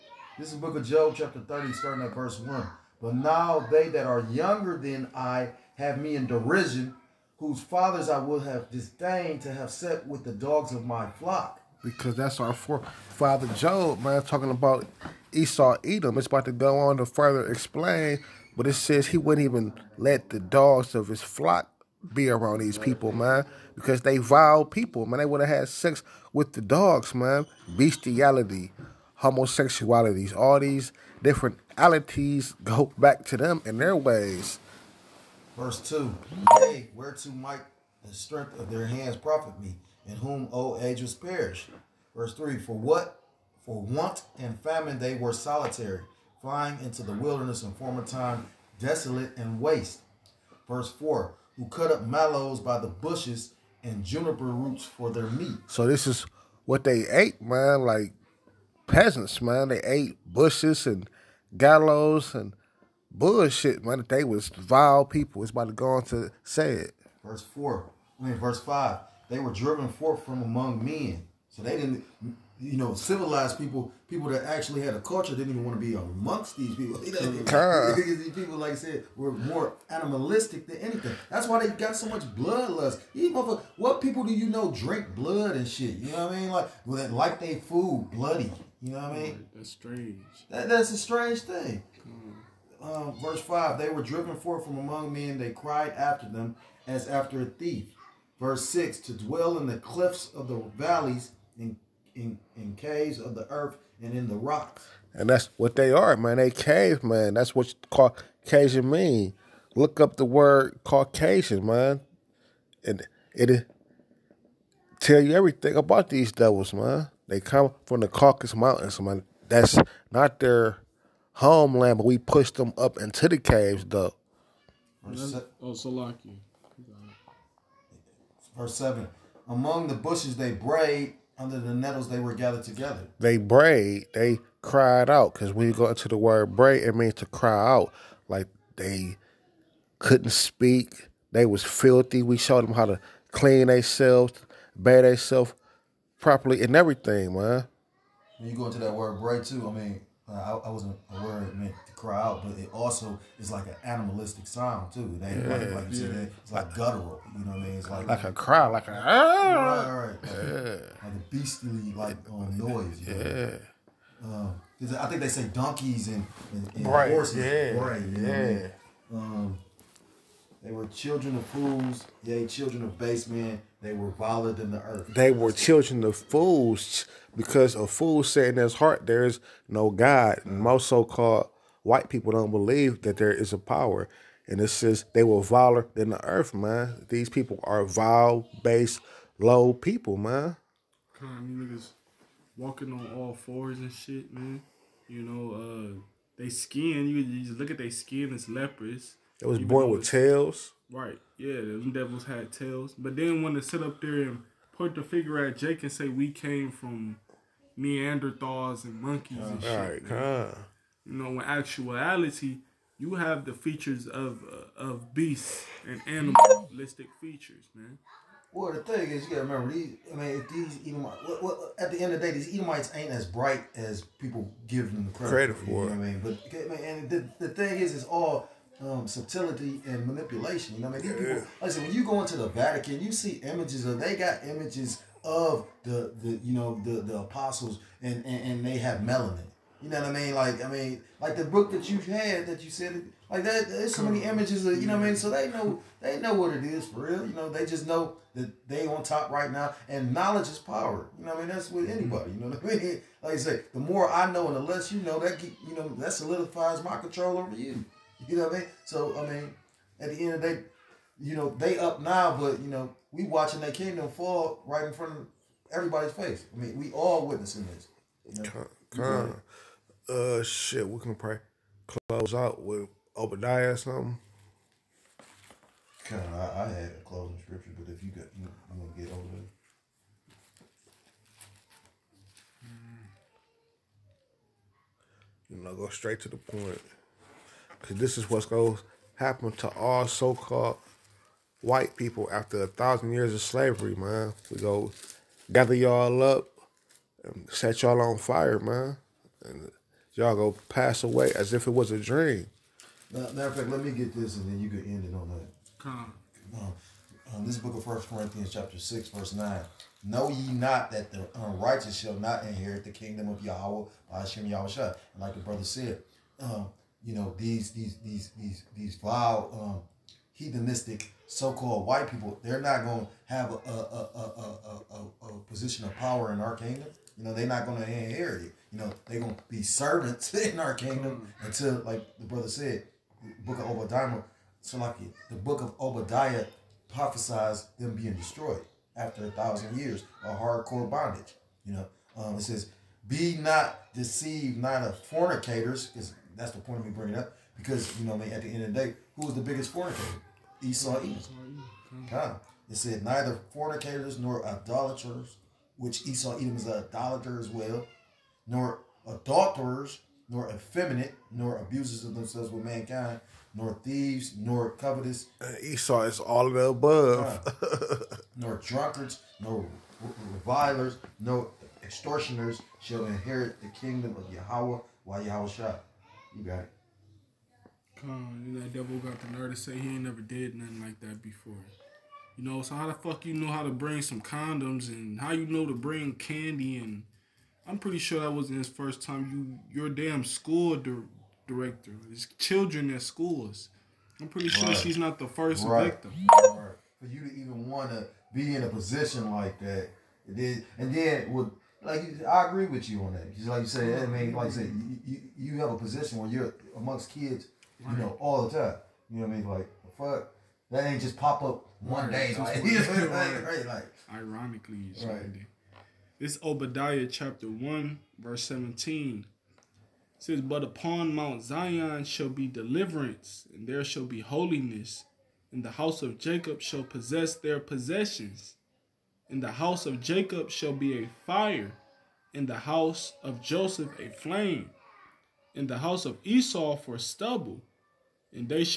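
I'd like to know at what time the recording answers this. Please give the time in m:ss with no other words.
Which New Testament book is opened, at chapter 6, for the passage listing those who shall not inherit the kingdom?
5:07.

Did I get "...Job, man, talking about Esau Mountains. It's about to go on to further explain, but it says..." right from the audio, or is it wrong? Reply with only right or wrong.
wrong.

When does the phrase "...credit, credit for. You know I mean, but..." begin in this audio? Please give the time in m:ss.
3:45.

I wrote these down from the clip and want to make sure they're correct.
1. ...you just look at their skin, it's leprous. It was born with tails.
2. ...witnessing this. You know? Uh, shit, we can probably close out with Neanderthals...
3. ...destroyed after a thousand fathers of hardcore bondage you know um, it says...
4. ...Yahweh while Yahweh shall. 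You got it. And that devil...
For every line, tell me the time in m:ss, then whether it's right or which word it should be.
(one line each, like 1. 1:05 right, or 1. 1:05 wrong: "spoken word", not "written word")
1. 3:17 right
2. 4:27 wrong: "Obadiah", not "Neanderthals"
3. 5:38 wrong: "years", not "fathers"
4. 6:14 right.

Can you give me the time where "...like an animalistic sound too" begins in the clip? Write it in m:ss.
2:33.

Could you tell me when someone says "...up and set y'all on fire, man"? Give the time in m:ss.
4:56.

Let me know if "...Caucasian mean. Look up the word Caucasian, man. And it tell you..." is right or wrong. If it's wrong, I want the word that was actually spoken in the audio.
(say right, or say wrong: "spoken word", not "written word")
right.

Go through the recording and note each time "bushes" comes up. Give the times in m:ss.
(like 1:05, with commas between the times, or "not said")
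0:52, 1:00, 2:09.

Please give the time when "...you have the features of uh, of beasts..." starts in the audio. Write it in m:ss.
3:32.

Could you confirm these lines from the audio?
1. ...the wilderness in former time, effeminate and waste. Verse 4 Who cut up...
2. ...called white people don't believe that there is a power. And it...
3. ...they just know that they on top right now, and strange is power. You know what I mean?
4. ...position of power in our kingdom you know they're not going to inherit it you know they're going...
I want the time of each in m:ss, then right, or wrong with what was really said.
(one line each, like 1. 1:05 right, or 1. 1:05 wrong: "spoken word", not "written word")
1. 0:47 wrong: "desolate", not "effeminate"
2. 3:01 right
3. 4:07 wrong: "knowledge", not "strange"
4. 5:25 right.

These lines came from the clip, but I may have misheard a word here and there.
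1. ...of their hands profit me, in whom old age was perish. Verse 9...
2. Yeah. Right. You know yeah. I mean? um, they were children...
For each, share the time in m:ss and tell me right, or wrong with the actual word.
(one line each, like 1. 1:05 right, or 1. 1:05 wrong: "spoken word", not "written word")
1. 0:38 wrong: "3", not "9"
2. 2:47 right.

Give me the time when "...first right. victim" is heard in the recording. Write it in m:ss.
6:35.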